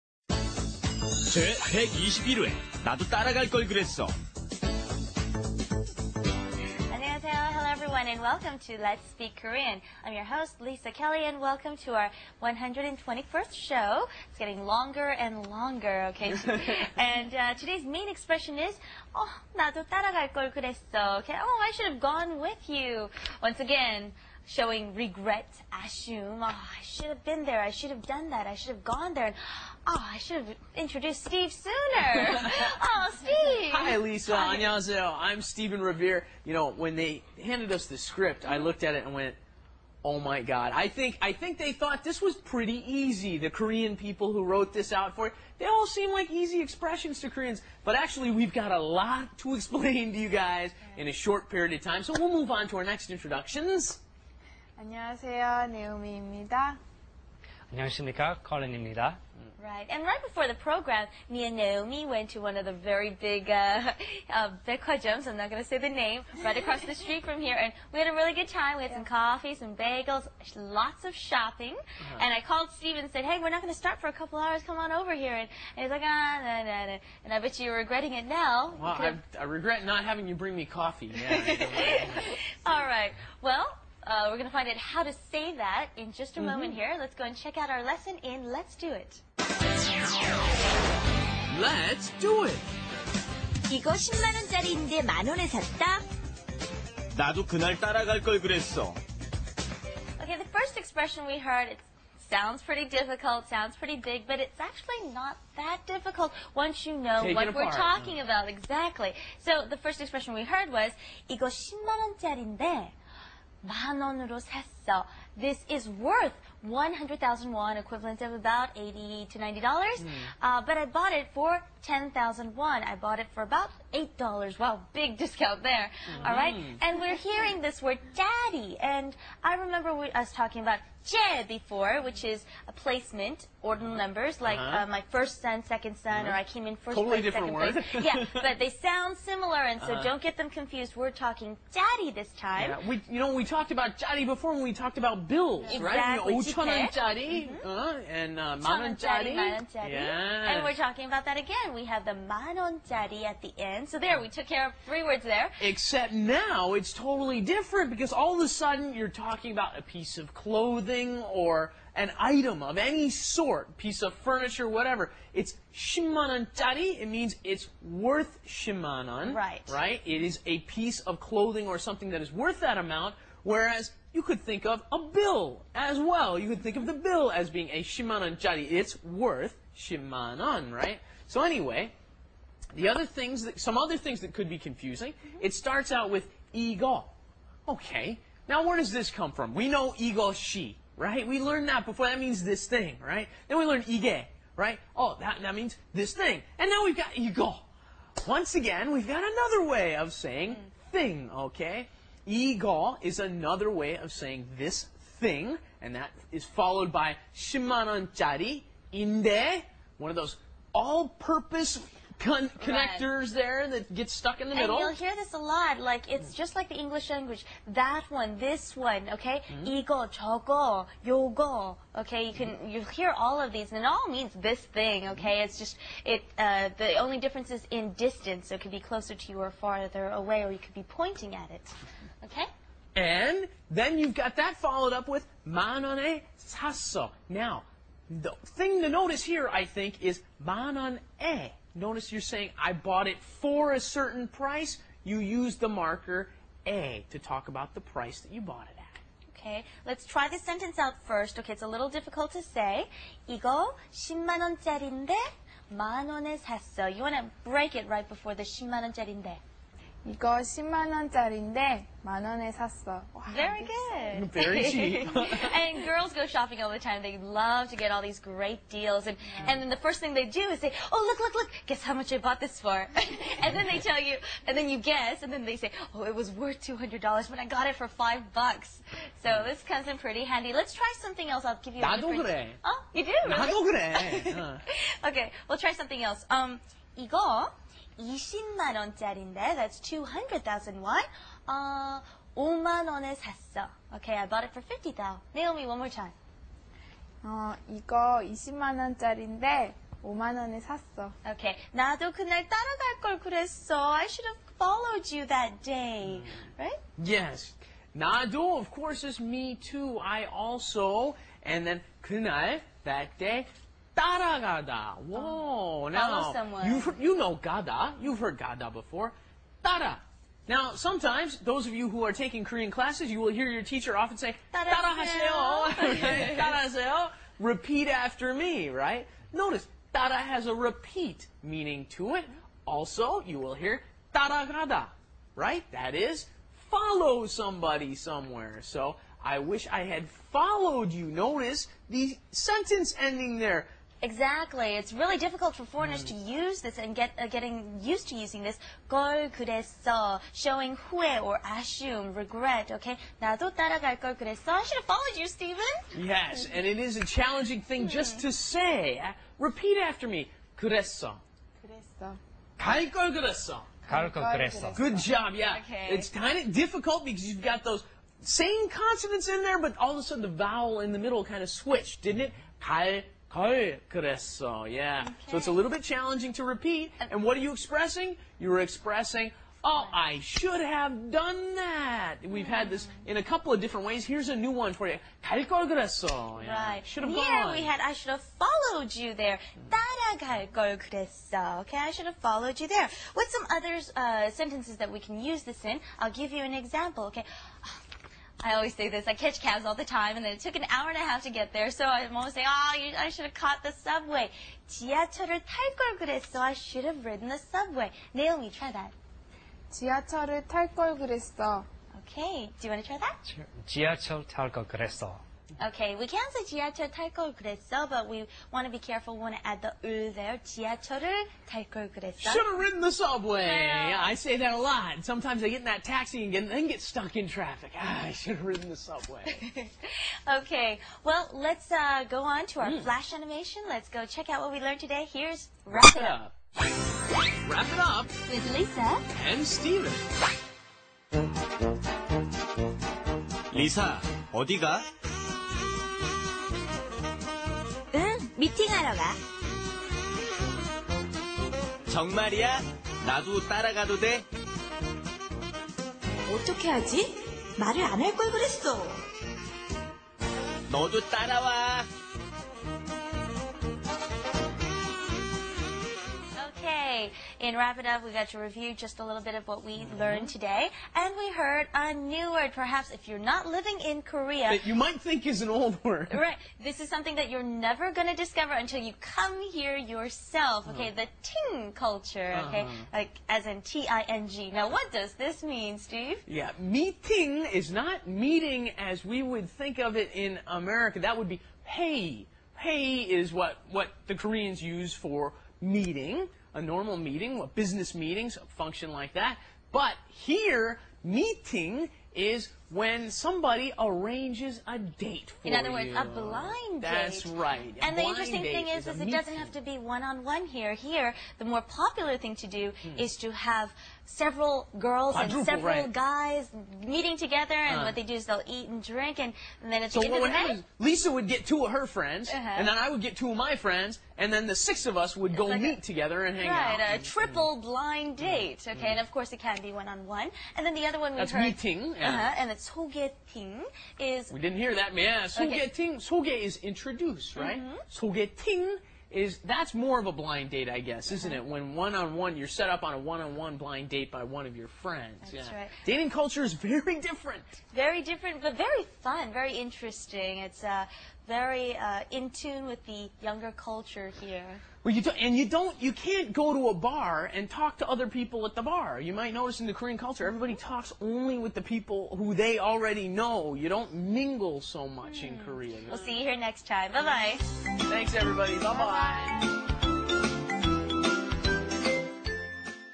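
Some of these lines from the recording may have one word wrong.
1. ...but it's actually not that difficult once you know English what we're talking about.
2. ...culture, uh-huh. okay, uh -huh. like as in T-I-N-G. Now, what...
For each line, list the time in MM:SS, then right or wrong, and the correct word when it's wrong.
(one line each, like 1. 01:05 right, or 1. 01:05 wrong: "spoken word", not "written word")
1. 01:44 wrong: "Take", not "English"
2. 08:01 right.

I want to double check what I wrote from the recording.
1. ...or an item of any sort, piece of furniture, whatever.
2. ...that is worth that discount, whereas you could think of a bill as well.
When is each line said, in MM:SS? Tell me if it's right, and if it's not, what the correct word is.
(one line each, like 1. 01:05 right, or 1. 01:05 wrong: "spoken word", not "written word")
1. 02:41 right
2. 02:52 wrong: "amount", not "discount".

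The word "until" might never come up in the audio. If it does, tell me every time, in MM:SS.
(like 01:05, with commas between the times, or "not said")
07:58.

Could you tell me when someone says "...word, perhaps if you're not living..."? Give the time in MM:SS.
07:52.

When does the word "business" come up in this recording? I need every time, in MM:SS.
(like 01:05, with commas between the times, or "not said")
08:17.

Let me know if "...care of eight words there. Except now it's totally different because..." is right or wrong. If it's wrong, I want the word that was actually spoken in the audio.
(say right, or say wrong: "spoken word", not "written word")
wrong: "three", not "eight".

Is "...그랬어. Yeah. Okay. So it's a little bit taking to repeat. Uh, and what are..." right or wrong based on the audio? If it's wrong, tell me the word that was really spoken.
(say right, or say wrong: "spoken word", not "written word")
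wrong: "challenging", not "taking".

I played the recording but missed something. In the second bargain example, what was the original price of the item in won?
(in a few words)
200,000 won.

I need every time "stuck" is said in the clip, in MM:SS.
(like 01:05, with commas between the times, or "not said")
03:34, 07:06.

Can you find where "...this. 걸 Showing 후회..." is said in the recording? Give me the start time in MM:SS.
05:48.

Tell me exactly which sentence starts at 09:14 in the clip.
Well, you do, and you don't, you can't go to a bar and talk to other people at the bar.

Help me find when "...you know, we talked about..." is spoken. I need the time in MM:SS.
02:23.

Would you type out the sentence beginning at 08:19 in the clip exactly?
But here, meeting is when somebody arranges a date for you.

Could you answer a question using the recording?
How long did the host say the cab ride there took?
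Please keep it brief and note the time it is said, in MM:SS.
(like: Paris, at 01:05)
An hour and a half, at 06:40.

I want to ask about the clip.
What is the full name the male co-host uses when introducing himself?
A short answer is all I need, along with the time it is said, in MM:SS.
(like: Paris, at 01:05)
Stephen Revere, at 00:35.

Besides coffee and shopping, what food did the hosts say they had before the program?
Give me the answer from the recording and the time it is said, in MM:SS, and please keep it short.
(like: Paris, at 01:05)
Bagels, at 01:09.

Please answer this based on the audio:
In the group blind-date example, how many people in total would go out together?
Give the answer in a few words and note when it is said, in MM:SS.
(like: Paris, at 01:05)
6, at 08:44.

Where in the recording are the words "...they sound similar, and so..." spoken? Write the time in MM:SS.
02:18.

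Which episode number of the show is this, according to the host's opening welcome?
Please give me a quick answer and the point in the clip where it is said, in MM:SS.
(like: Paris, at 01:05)
121st, at 00:12.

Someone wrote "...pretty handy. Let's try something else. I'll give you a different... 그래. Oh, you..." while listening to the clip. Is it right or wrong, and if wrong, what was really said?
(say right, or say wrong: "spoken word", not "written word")
right.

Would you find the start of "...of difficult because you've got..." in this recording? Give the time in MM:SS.
06:06.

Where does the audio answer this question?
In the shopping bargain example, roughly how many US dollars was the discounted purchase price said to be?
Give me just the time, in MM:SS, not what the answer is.
02:03.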